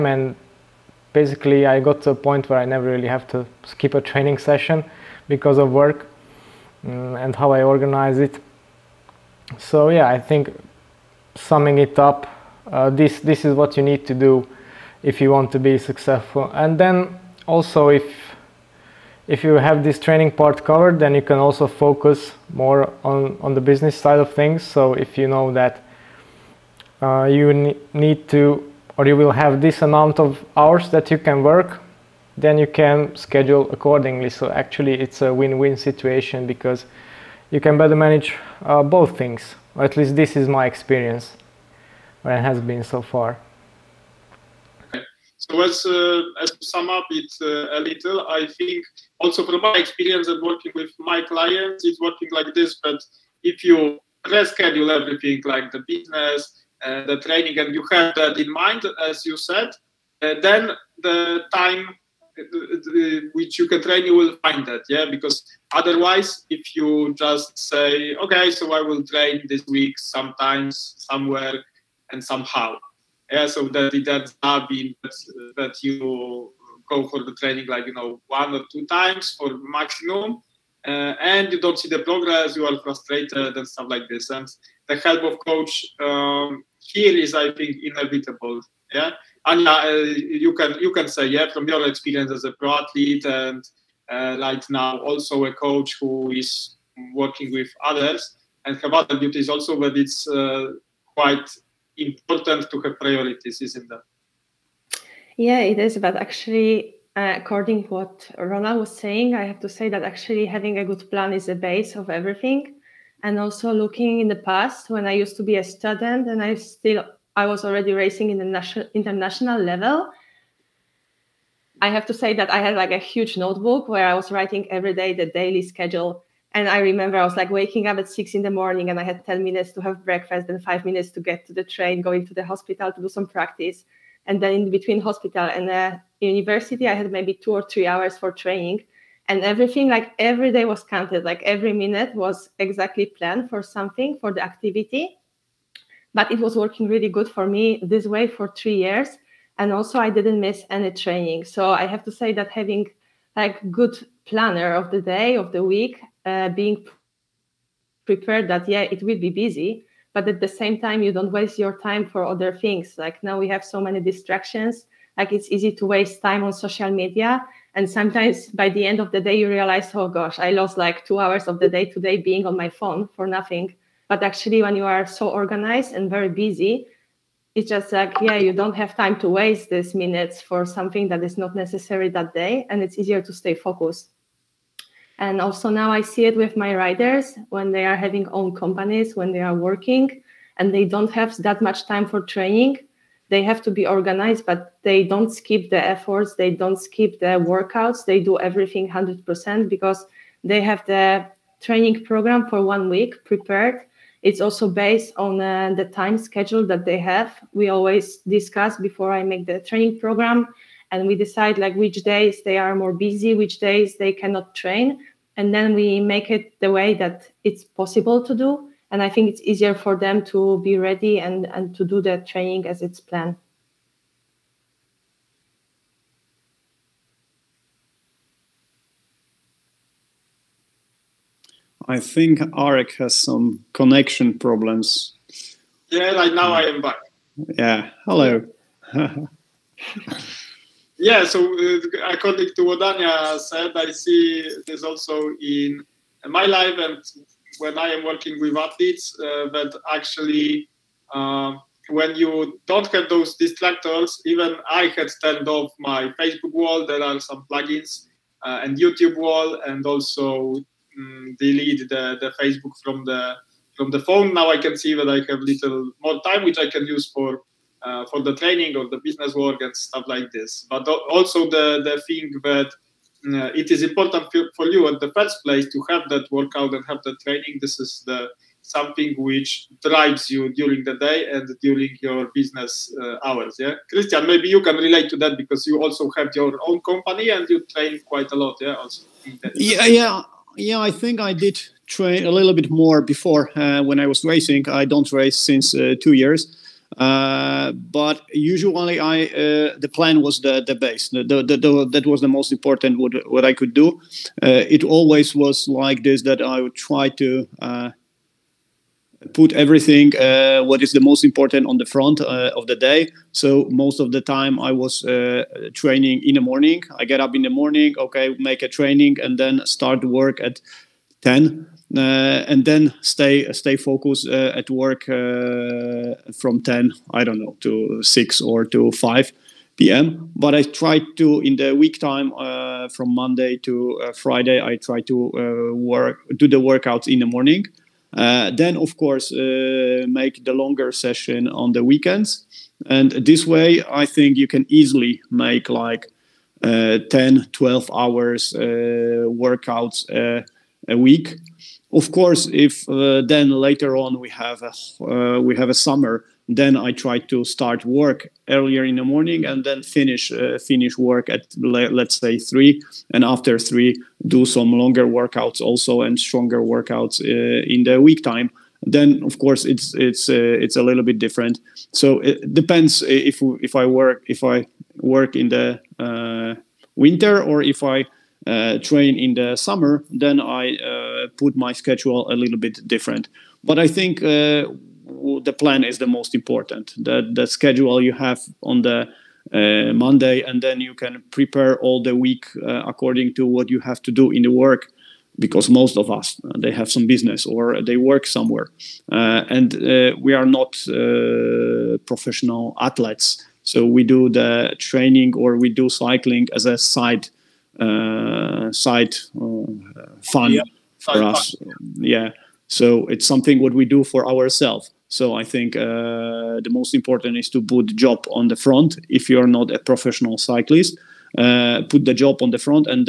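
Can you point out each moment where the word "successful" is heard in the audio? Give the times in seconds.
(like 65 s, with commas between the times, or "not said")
15 s.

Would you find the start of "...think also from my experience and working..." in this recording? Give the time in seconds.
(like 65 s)
48 s.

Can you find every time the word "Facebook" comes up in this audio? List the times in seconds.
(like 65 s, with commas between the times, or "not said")
256 s, 262 s.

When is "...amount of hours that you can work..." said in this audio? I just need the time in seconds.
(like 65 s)
29 s.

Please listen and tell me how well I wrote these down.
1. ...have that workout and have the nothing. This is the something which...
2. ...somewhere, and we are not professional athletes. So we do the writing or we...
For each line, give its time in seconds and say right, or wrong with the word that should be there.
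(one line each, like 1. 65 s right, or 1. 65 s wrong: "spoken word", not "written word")
1. 275 s wrong: "training", not "nothing"
2. 398 s wrong: "training", not "writing".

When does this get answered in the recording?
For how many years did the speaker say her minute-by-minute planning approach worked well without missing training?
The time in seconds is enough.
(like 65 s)
148 s.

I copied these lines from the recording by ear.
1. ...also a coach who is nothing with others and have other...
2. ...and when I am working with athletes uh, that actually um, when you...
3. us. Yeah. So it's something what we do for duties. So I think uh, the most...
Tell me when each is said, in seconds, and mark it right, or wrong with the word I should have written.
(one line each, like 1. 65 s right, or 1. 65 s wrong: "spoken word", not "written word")
1. 95 s wrong: "working", not "nothing"
2. 246 s right
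3. 411 s wrong: "ourselves", not "duties".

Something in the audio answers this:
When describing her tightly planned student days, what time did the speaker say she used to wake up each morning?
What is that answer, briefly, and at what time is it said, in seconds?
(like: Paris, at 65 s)
6 in the morning, at 128 s.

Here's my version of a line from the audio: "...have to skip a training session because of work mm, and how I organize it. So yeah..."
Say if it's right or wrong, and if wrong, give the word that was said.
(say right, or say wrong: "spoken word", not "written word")
right.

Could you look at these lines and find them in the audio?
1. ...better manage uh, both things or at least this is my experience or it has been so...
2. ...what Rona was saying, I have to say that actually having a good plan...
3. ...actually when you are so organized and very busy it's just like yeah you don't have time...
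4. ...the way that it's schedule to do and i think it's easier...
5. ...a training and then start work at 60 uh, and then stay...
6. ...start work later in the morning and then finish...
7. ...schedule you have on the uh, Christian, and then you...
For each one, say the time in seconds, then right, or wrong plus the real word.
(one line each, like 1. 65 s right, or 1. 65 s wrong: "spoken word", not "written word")
1. 37 s right
2. 107 s right
3. 174 s right
4. 216 s wrong: "possible", not "schedule"
5. 318 s wrong: "10", not "60"
6. 357 s wrong: "earlier", not "later"
7. 387 s wrong: "Monday", not "Christian".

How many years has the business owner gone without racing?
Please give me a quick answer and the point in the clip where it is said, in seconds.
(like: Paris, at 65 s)
2, at 296 s.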